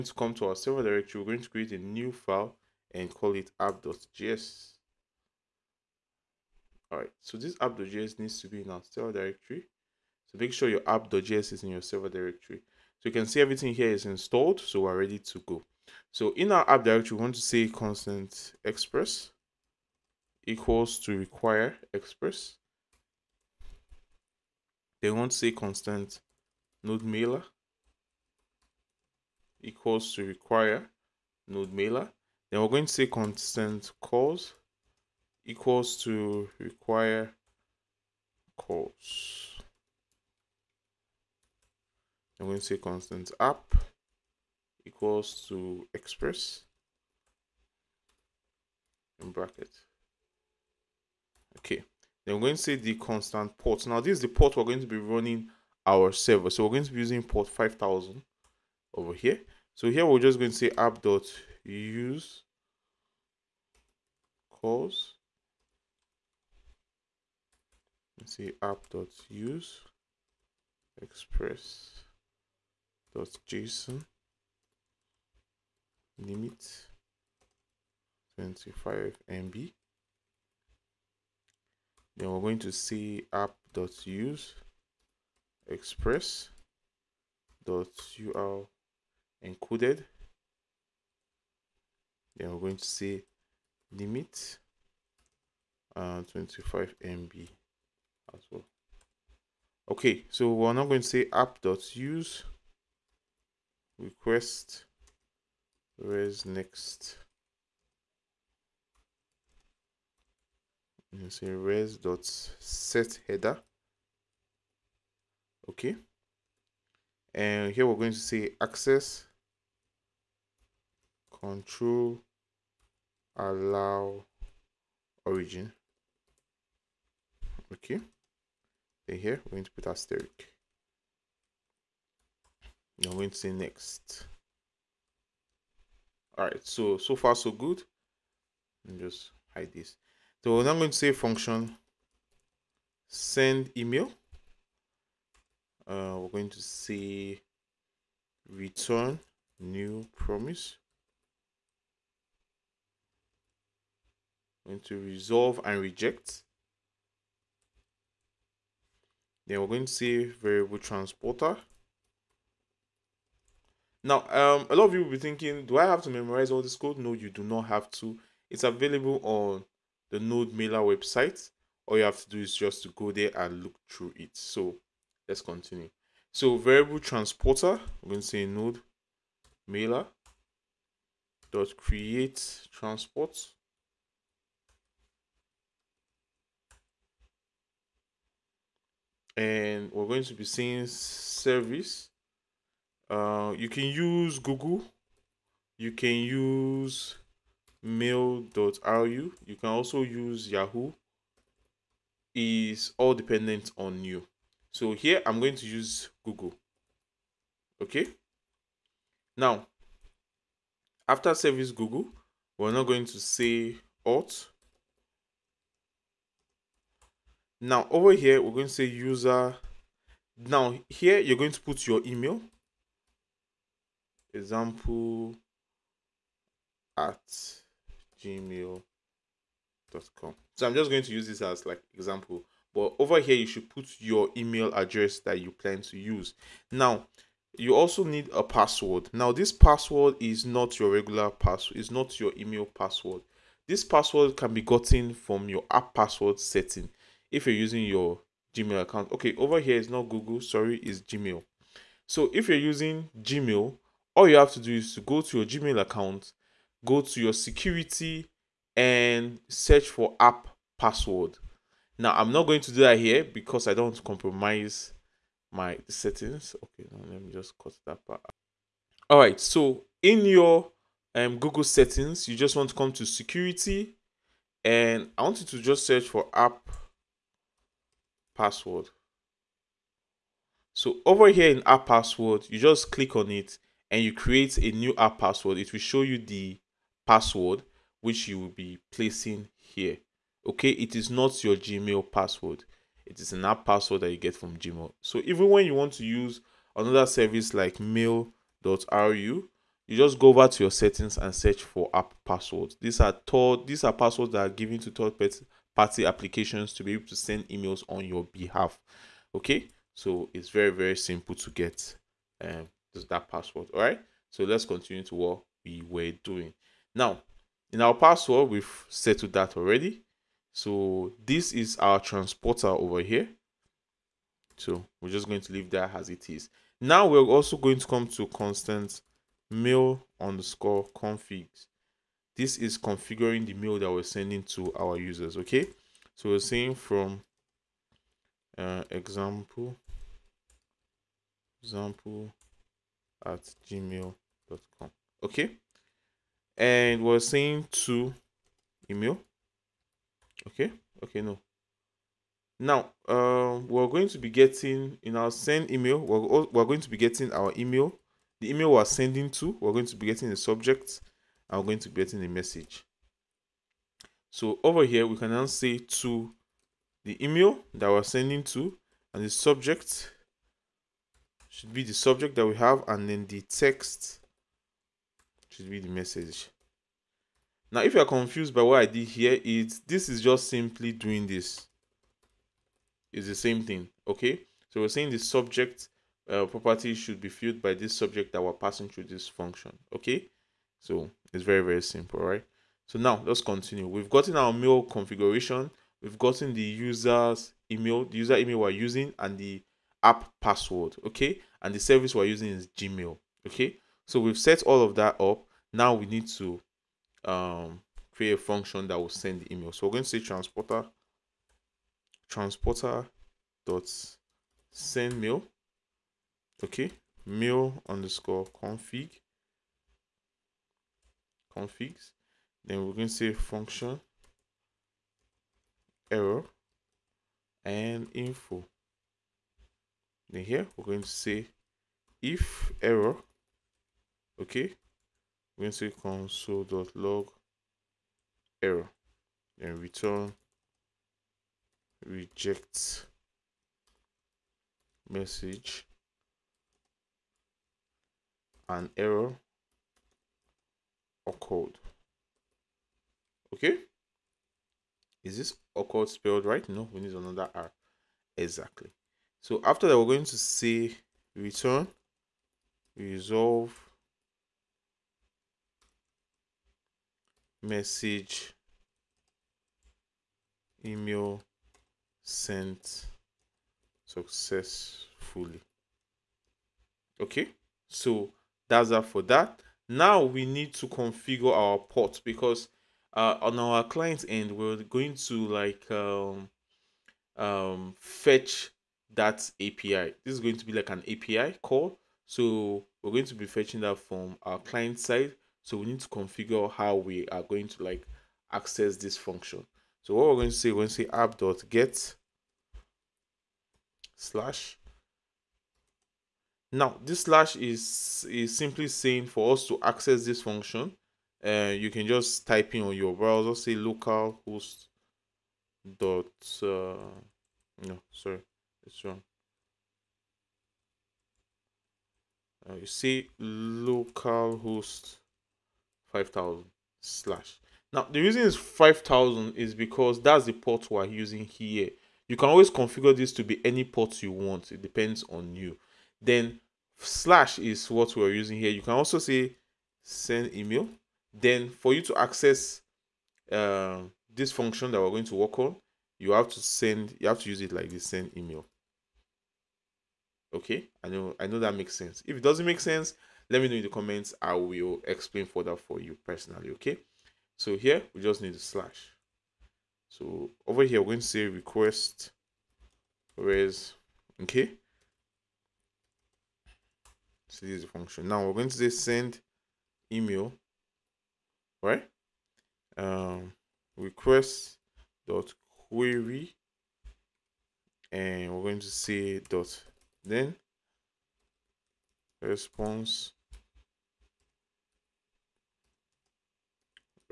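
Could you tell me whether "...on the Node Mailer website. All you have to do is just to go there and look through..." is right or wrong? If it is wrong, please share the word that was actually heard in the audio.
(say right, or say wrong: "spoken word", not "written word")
right.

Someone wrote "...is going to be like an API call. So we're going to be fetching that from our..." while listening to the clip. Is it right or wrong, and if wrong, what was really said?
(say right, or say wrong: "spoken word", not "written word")
right.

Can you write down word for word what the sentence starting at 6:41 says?
And the service we're using is Gmail, okay?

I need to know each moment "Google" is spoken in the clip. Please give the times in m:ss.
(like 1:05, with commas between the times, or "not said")
3:14, 3:26, 3:31, 4:10, 4:31.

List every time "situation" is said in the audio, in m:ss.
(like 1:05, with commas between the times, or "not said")
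not said.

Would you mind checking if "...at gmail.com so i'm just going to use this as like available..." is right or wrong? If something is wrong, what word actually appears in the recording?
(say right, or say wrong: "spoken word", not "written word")
wrong: "example", not "available".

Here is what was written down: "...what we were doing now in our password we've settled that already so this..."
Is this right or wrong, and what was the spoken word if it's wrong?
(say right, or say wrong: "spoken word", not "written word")
right.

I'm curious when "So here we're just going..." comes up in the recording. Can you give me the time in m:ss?
0:59.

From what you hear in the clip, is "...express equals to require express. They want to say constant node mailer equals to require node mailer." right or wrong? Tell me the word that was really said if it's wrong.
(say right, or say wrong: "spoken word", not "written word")
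right.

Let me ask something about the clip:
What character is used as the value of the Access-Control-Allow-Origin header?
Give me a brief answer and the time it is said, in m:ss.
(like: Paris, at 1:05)
asterisk, at 2:09.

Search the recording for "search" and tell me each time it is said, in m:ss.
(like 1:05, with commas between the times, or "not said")
4:19, 4:35, 5:01.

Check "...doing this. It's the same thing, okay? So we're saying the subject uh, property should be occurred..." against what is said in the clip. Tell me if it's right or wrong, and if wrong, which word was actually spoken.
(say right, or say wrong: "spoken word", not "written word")
wrong: "filled", not "occurred".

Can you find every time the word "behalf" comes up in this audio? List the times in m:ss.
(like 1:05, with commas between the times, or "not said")
5:08.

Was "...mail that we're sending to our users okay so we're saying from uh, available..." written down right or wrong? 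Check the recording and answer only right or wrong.
wrong.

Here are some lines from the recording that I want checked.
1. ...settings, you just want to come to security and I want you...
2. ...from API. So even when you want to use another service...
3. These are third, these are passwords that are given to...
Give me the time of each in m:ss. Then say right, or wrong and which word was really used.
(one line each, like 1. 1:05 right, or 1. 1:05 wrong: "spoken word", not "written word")
1. 4:31 right
2. 4:54 wrong: "Gmail", not "API"
3. 5:02 right.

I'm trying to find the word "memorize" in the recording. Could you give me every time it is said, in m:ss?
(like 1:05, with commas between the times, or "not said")
2:46.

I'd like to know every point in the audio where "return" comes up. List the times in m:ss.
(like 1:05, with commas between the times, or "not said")
2:28, 7:19, 7:41.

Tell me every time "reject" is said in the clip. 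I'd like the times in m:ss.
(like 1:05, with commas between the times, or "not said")
2:35, 7:22.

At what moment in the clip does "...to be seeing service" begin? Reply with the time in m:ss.
3:10.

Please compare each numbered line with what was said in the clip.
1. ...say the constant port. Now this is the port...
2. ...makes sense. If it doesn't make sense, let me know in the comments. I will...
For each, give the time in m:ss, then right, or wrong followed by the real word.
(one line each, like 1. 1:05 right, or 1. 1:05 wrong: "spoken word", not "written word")
1. 0:52 right
2. 9:11 right.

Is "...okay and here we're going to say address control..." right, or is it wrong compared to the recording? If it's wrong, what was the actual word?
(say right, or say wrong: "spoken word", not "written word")
wrong: "access", not "address".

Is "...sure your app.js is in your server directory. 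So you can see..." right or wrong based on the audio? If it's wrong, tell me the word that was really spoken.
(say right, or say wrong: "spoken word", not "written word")
right.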